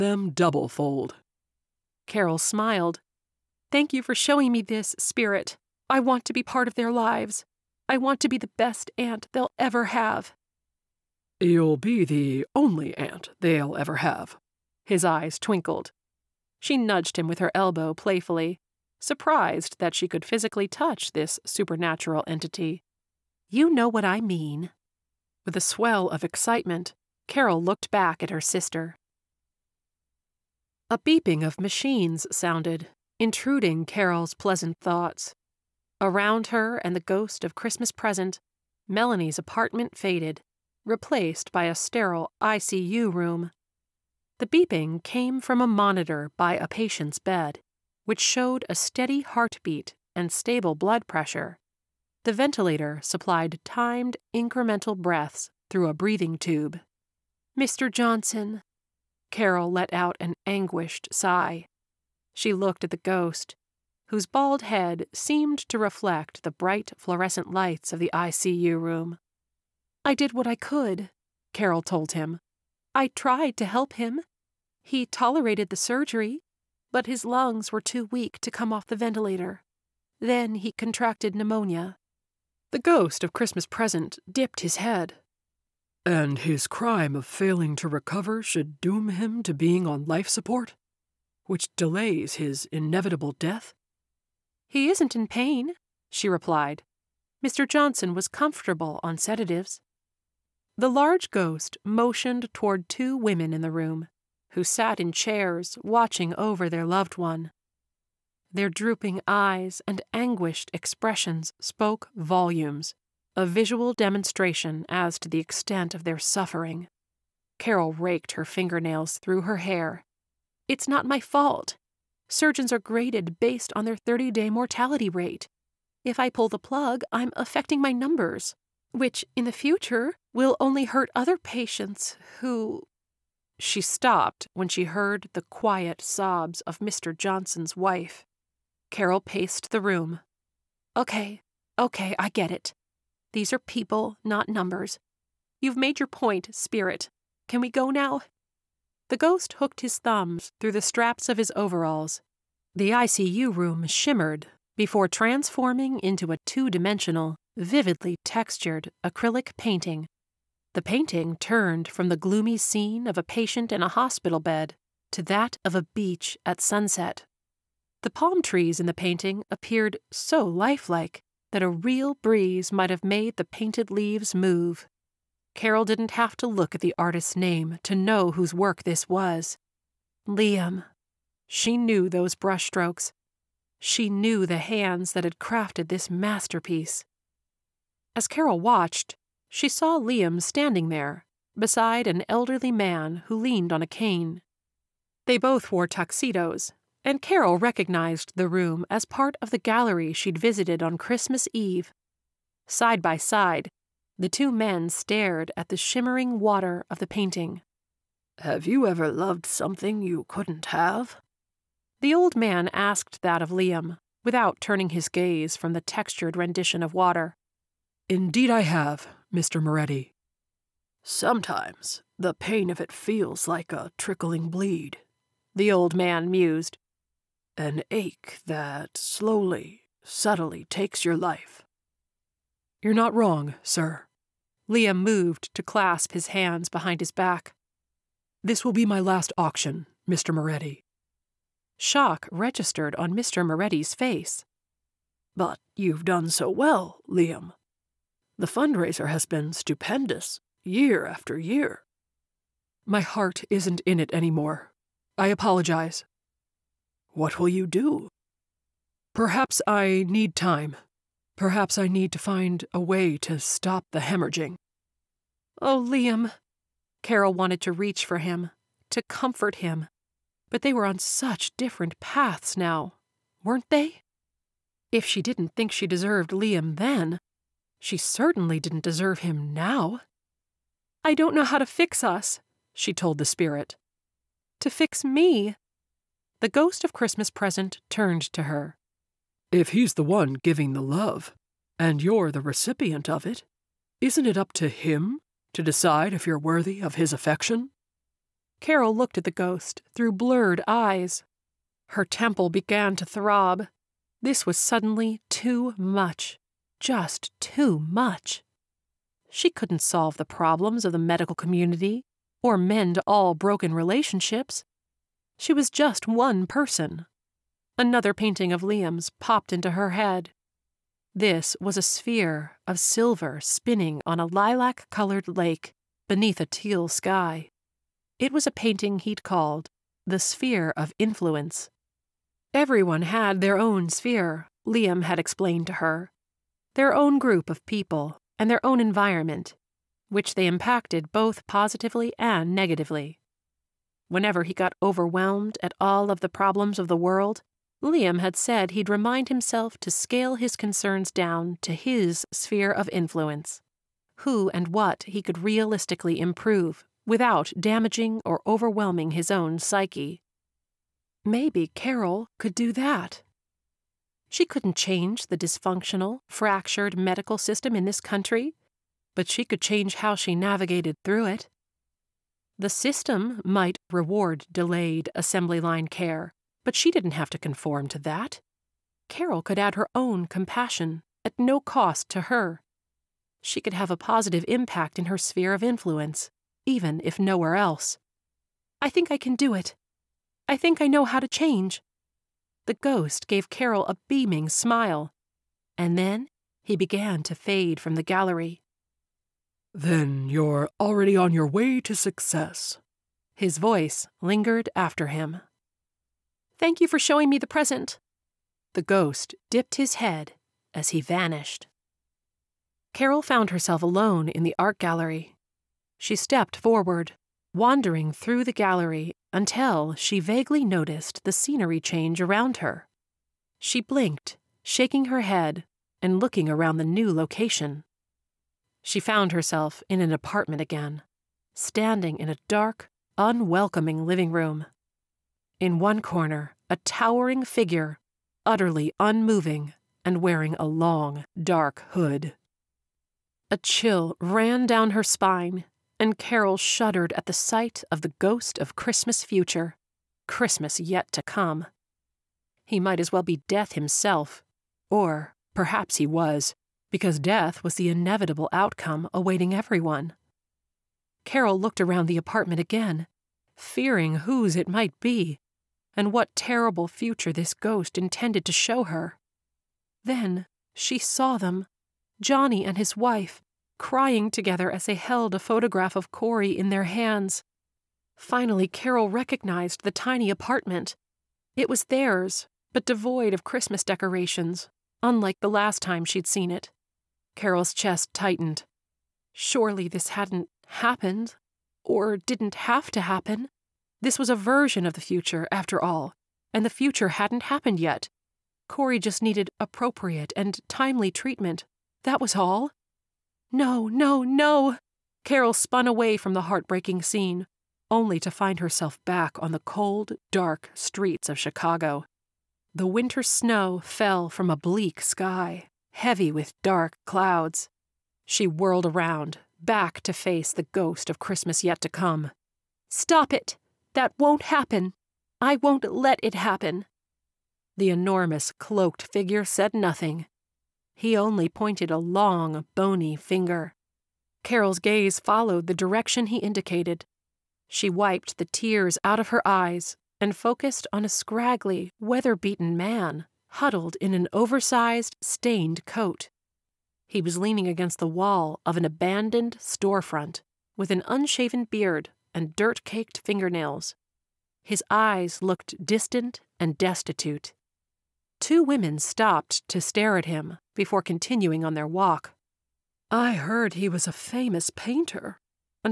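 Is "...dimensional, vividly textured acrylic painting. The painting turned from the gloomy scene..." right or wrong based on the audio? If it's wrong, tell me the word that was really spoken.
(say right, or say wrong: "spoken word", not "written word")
right.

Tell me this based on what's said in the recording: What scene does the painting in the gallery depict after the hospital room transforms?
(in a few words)
A beach at sunset.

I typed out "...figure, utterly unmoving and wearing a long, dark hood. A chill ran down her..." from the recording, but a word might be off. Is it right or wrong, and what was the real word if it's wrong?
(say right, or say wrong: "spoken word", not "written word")
right.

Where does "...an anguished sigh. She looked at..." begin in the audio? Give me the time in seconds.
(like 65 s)
60 s.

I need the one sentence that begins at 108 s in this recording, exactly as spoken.
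Their drooping eyes and anguished expressions spoke volumes, a visual demonstration as to the extent of their suffering.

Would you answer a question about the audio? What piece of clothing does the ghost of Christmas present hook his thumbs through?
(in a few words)
Overalls.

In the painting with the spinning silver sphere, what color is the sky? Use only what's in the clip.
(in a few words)
Teal.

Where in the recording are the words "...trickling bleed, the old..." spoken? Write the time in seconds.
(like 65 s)
223 s.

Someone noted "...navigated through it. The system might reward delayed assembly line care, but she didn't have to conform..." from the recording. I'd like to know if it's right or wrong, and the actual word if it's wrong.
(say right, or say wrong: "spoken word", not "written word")
right.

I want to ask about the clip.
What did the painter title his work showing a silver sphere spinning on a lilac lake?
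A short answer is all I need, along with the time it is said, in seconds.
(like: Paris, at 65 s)
The Sphere of Influence, at 330 s.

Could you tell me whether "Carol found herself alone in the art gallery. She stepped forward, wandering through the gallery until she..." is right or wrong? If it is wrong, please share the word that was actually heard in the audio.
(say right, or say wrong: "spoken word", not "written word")
right.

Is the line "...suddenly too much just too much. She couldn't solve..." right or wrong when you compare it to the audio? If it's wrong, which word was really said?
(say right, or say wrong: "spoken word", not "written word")
right.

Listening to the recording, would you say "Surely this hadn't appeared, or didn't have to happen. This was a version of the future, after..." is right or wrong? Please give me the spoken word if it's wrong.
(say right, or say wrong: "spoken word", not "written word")
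wrong: "happened", not "appeared".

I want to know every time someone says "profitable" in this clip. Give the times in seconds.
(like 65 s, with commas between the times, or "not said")
not said.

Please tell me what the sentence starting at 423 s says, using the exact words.
She blinked, shaking her head and looking around the new location.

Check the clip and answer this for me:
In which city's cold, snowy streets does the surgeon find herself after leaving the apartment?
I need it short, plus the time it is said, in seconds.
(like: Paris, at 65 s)
Chicago, at 511 s.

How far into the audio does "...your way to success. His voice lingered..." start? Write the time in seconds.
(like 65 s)
401 s.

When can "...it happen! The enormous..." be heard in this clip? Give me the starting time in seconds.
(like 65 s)
526 s.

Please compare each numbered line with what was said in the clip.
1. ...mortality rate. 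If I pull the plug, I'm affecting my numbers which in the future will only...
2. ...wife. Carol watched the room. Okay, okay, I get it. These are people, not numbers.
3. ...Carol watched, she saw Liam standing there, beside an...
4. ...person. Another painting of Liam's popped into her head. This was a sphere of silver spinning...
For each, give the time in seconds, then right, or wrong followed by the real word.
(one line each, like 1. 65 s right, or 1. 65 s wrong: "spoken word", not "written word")
1. 124 s right
2. 137 s wrong: "paced", not "watched"
3. 188 s right
4. 316 s right.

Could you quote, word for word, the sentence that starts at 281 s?
I don't know how to fix us, she told the spirit.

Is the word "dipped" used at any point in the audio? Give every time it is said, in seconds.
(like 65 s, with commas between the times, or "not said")
84 s, 409 s.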